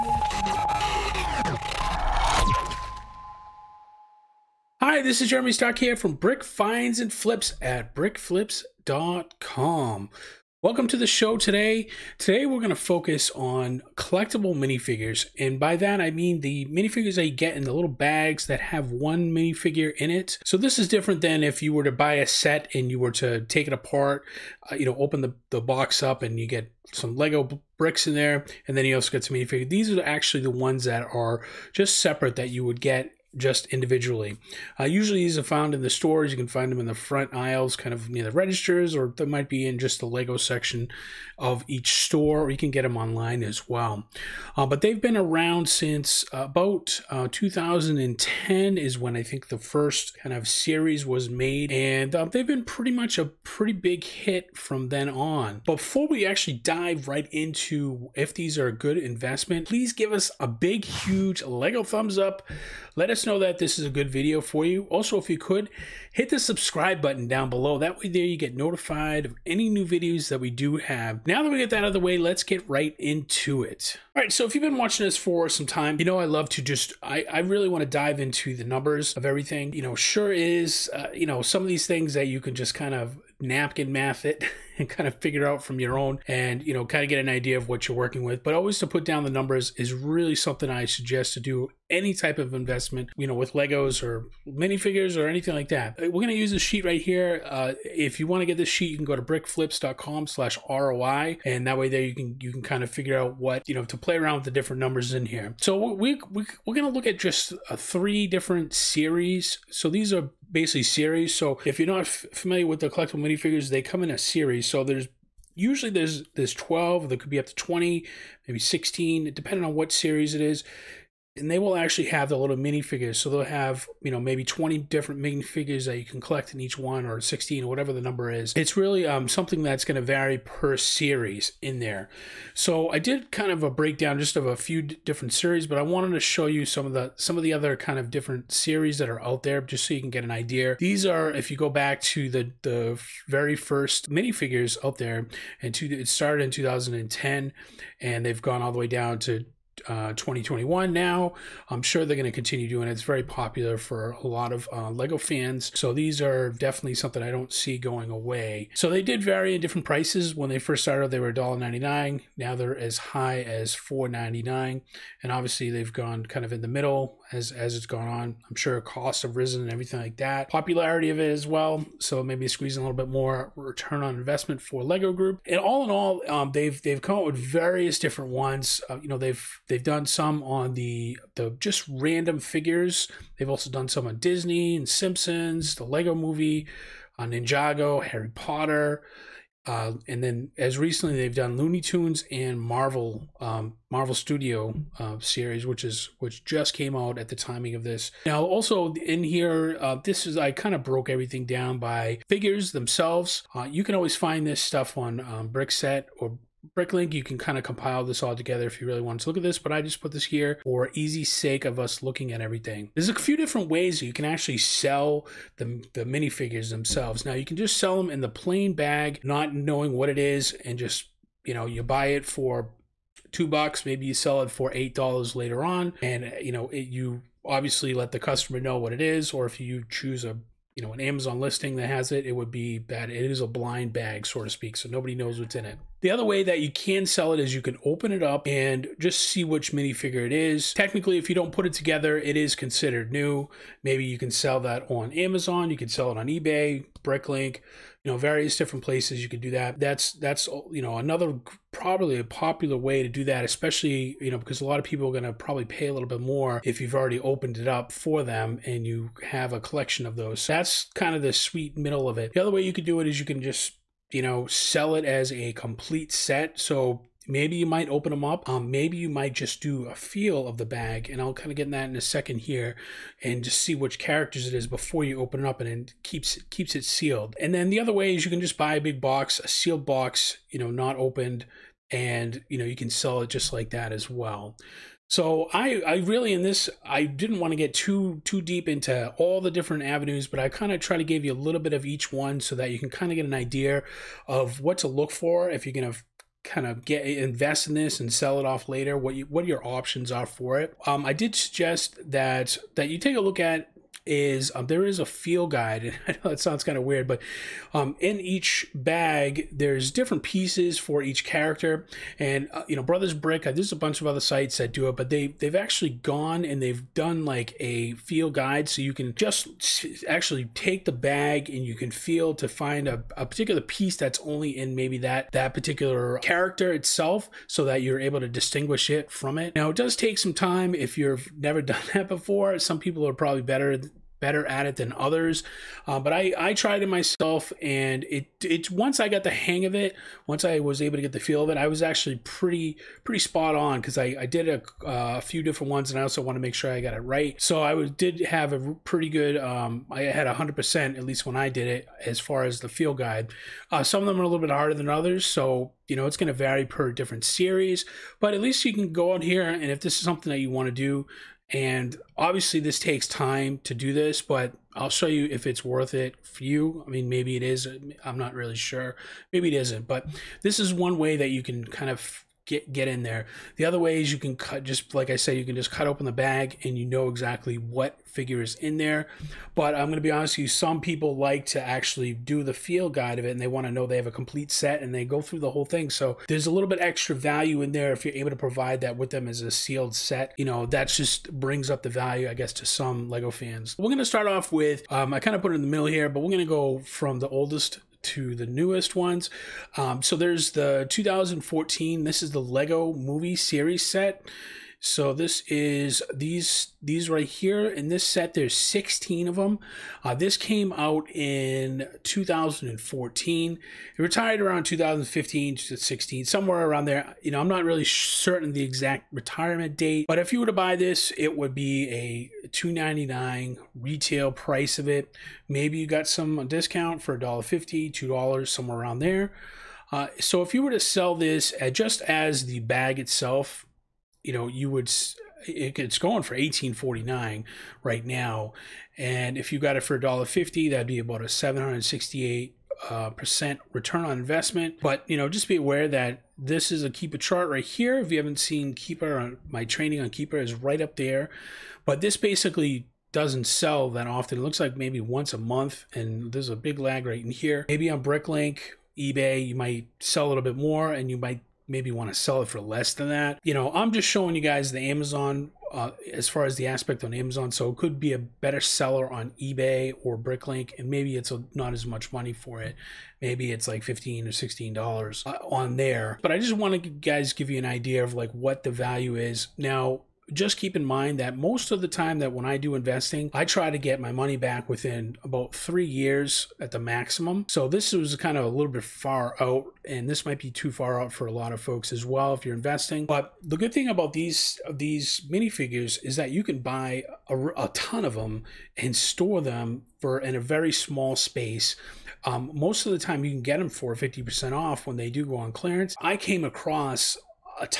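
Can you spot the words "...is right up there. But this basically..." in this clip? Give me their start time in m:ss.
7:30.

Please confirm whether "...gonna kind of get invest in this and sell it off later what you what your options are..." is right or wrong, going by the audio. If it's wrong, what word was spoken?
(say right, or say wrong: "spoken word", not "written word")
right.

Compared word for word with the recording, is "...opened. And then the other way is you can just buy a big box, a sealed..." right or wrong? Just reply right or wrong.
wrong.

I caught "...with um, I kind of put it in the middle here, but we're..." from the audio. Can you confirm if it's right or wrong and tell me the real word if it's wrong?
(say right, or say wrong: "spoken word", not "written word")
right.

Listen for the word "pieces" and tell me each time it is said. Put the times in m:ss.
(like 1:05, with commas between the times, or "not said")
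5:10, 5:23.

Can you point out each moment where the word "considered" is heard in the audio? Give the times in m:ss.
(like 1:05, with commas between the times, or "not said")
4:02.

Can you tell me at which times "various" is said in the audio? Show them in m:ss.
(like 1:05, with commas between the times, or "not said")
2:57, 4:08.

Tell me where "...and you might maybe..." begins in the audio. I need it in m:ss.
7:40.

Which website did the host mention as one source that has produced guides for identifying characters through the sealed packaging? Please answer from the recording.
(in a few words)
Brothers Brick.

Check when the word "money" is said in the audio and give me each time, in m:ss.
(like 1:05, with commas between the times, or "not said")
7:52, 8:04.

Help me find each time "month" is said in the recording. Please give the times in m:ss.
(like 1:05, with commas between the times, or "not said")
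7:35.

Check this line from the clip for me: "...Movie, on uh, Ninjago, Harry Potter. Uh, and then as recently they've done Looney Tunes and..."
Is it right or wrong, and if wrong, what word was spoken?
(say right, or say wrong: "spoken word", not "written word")
right.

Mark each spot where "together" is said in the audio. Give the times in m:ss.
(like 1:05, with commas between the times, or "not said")
3:28, 4:01.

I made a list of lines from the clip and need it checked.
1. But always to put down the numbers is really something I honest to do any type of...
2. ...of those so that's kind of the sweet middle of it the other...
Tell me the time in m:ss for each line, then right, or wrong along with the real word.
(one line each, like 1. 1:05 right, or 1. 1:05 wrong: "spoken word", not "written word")
1. 1:28 wrong: "suggest", not "honest"
2. 4:20 right.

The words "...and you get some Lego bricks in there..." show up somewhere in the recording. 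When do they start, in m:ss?
0:26.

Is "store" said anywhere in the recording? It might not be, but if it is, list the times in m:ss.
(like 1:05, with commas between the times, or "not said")
0:35, 0:41, 8:18.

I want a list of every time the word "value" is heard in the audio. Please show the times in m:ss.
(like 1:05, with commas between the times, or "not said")
6:27, 6:31, 7:58.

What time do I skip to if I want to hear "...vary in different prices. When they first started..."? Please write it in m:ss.
2:39.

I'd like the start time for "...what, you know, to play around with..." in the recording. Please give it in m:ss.
1:43.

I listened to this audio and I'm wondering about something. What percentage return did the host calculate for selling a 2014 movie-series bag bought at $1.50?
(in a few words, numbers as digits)
768%.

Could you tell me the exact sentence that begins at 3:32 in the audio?
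There's a few different ways you can actually sell the, the minifigures themselves.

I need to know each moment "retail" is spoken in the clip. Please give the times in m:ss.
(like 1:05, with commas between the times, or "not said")
7:03.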